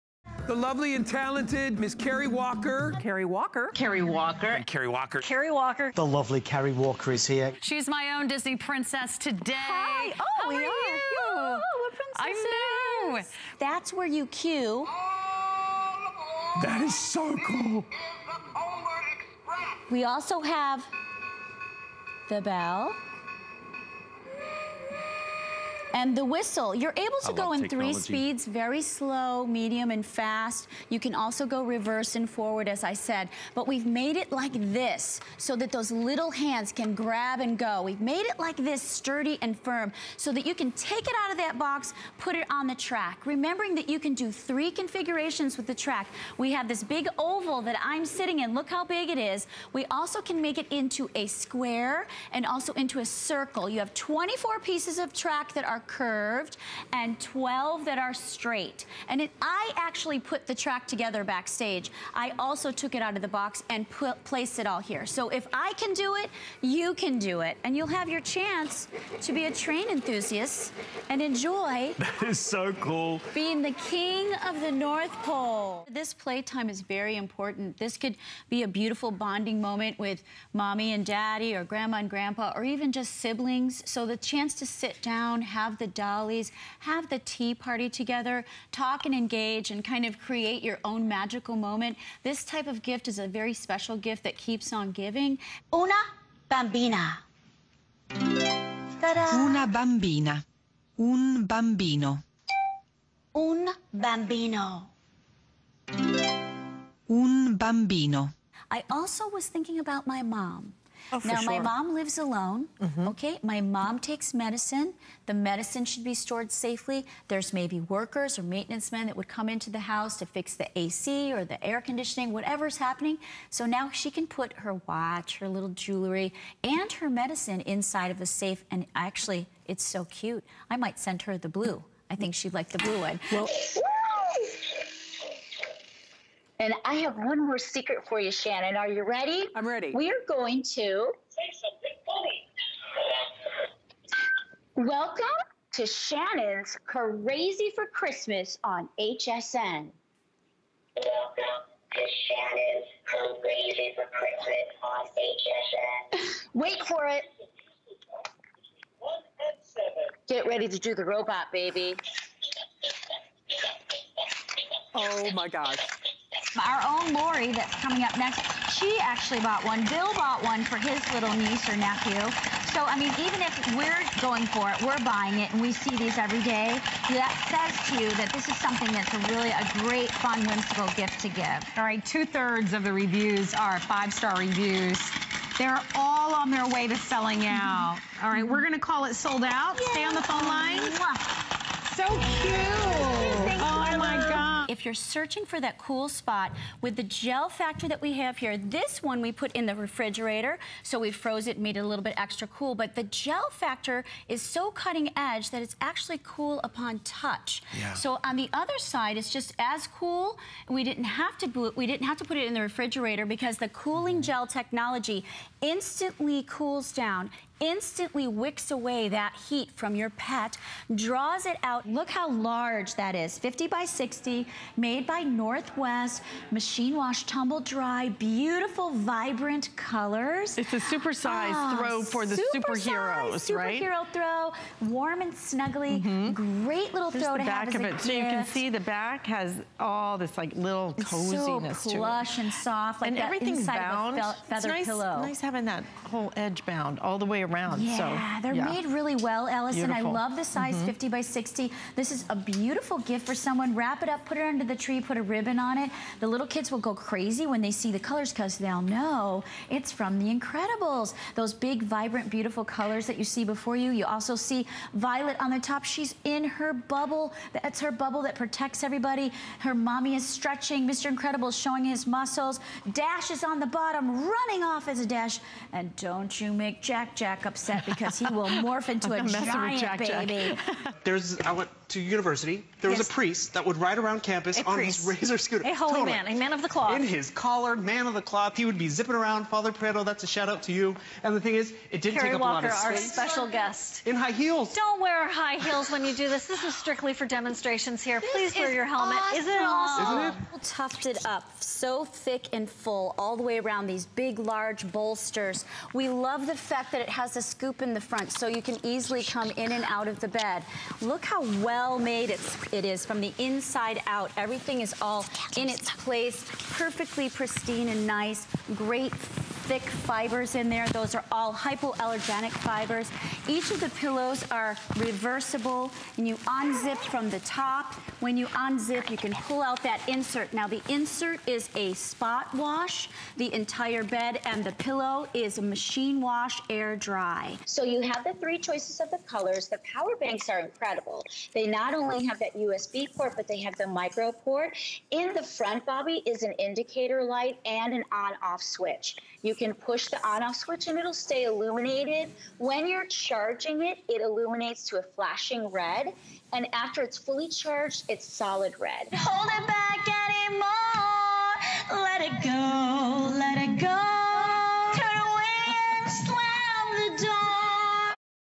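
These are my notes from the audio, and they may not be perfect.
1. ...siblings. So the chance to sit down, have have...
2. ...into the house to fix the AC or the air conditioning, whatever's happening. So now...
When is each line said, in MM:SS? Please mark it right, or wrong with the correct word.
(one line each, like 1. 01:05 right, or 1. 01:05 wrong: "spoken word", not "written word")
1. 01:23 right
2. 01:59 right.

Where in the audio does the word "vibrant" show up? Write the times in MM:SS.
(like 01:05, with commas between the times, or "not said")
03:48, 04:21.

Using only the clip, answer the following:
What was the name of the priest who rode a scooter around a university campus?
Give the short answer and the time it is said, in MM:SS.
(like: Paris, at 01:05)
Father Prado, at 04:49.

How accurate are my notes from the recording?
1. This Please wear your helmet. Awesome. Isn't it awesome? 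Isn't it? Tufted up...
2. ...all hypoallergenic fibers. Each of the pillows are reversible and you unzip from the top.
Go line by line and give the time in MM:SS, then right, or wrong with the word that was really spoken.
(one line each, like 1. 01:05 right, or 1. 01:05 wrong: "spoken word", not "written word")
1. 04:58 right
2. 05:21 right.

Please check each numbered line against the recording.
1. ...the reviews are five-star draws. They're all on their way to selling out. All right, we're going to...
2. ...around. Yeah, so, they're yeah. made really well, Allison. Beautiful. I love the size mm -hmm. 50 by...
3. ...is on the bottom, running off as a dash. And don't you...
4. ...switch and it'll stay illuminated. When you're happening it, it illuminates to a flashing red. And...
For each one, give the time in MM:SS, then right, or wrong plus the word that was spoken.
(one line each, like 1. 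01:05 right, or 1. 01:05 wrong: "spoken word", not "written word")
1. 03:02 wrong: "reviews", not "draws"
2. 04:07 right
3. 04:33 right
4. 05:50 wrong: "charging", not "happening".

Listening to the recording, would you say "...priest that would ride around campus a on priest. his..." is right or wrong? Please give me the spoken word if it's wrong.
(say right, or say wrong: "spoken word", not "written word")
right.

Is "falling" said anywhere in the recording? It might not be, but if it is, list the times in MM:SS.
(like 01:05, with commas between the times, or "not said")
not said.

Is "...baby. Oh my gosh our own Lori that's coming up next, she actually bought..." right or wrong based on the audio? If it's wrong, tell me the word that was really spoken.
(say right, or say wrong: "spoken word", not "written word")
right.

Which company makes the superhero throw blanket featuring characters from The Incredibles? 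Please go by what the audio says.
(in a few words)
Northwest.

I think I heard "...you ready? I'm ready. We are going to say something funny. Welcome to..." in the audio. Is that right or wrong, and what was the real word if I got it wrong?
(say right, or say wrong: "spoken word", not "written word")
right.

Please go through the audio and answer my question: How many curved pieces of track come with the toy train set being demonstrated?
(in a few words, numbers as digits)
24.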